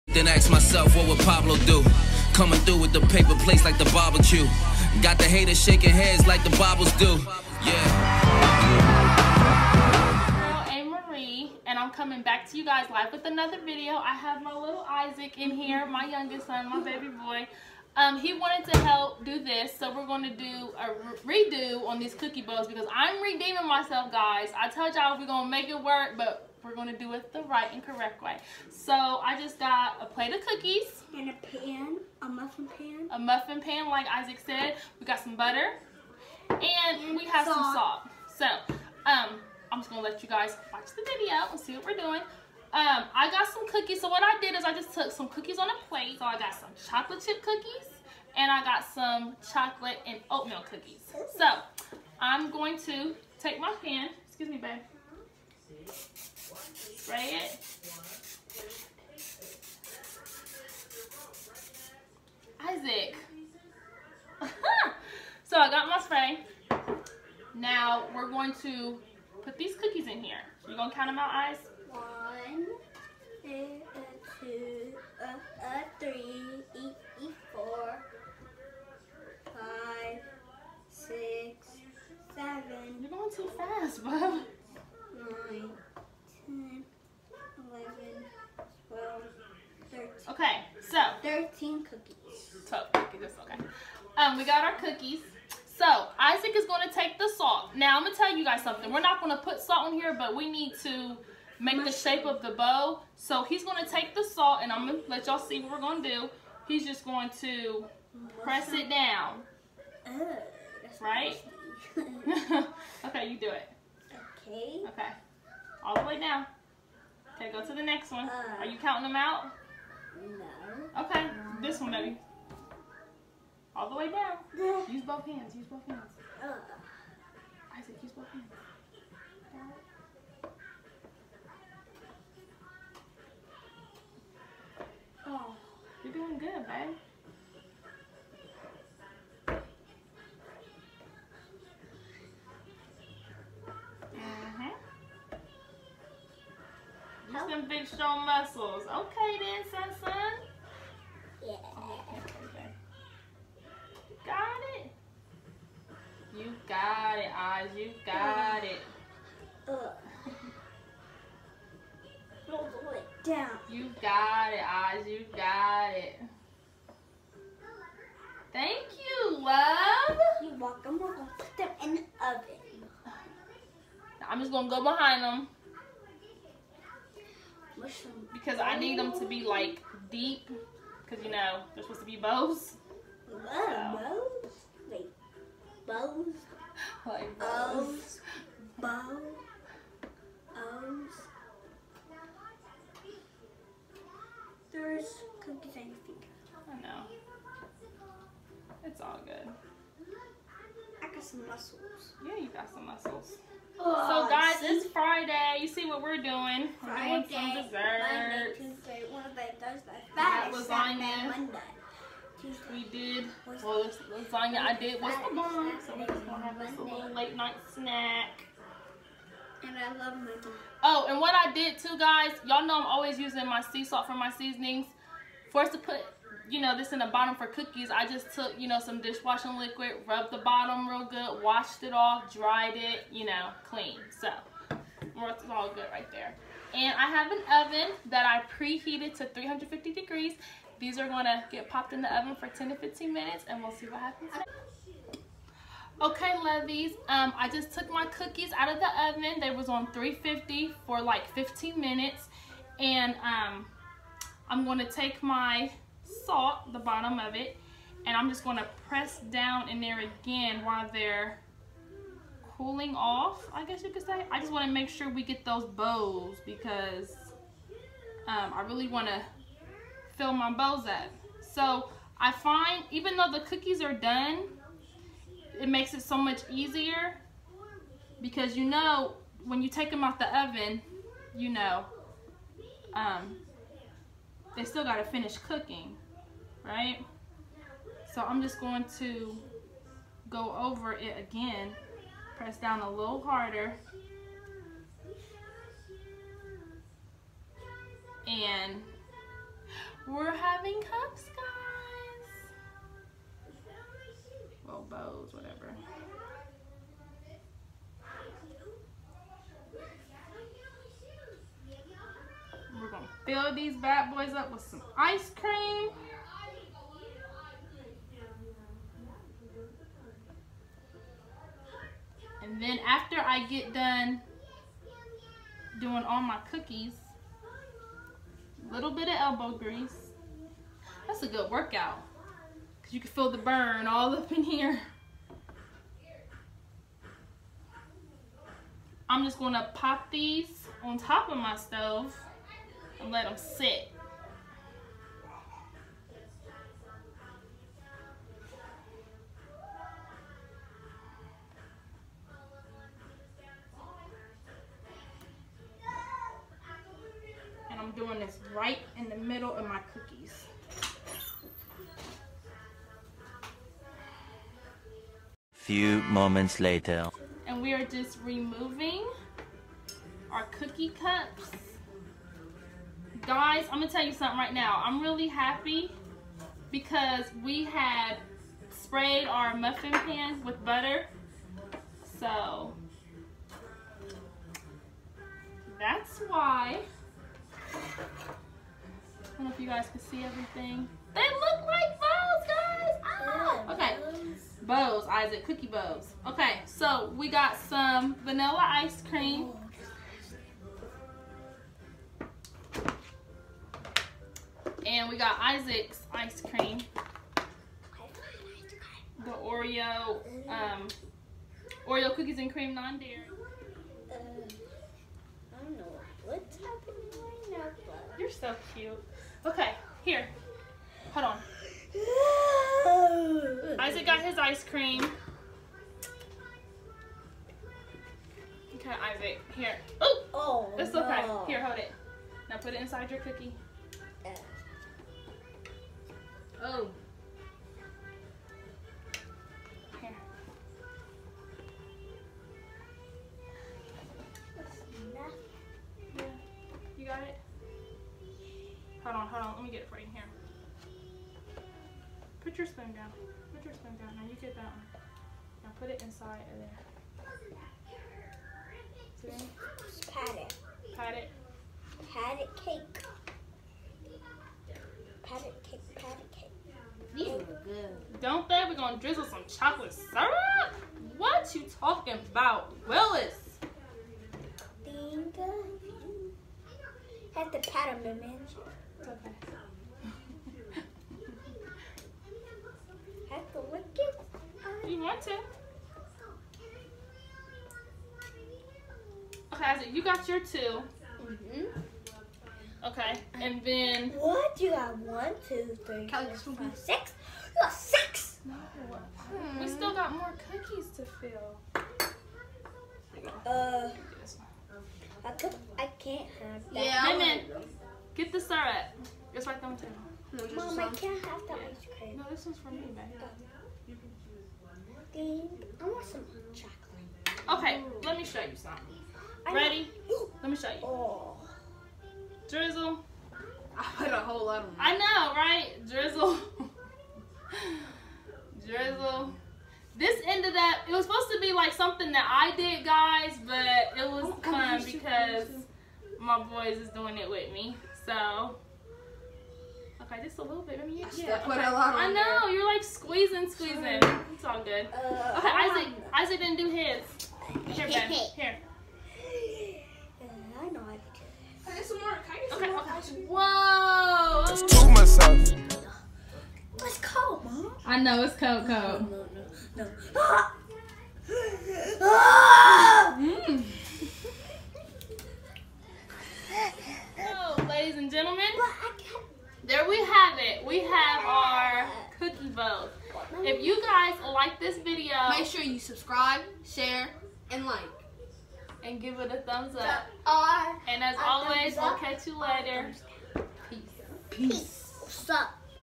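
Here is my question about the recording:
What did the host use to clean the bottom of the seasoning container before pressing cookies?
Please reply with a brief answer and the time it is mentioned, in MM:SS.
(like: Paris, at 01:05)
dishwashing liquid, at 03:49.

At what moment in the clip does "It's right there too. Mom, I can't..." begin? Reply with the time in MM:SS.
08:29.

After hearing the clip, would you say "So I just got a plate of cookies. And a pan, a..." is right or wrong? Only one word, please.
right.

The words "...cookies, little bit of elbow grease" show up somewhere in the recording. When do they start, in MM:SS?
05:26.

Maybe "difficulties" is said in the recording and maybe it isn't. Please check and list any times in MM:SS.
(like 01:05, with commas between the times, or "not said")
not said.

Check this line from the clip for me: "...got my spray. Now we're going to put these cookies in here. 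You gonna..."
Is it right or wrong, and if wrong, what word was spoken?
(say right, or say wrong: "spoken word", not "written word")
right.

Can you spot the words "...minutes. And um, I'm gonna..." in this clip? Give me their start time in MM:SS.
04:11.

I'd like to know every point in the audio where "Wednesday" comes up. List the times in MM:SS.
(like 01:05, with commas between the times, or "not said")
03:29.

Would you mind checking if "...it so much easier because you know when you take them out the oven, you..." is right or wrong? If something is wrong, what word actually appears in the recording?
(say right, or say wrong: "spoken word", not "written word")
right.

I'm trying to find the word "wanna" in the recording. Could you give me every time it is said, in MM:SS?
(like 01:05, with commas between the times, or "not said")
04:24, 04:28.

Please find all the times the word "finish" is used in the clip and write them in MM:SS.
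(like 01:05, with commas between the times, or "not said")
04:45.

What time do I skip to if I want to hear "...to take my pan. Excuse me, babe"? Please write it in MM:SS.
00:52.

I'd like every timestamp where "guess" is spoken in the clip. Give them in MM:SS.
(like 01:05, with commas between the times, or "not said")
04:23.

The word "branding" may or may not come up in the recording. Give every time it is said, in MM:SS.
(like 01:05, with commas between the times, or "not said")
not said.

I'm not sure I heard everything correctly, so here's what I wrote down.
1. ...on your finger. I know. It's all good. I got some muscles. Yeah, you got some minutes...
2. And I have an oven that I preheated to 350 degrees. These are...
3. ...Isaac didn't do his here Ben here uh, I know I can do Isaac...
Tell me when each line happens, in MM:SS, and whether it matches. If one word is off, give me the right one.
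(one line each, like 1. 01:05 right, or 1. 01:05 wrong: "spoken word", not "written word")
1. 03:15 wrong: "muscles", not "minutes"
2. 03:56 right
3. 09:06 wrong: "Okay", not "Isaac".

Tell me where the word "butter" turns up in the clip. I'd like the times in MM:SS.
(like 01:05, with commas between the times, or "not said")
00:35, 06:20.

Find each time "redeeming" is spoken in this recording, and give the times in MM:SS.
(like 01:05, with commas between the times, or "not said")
00:23.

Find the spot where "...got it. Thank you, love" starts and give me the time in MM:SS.
02:45.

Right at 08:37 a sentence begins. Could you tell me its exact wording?
Okay, let me show you something.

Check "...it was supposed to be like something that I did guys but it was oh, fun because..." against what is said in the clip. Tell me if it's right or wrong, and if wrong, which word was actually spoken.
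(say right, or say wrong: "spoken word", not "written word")
right.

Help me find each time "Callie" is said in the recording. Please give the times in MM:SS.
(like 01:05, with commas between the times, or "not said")
08:16.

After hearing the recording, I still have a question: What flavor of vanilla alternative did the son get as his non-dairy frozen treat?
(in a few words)
Oreo cookies and cream.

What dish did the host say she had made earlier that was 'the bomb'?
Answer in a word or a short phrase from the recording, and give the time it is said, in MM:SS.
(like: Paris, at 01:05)
lasagna, at 03:34.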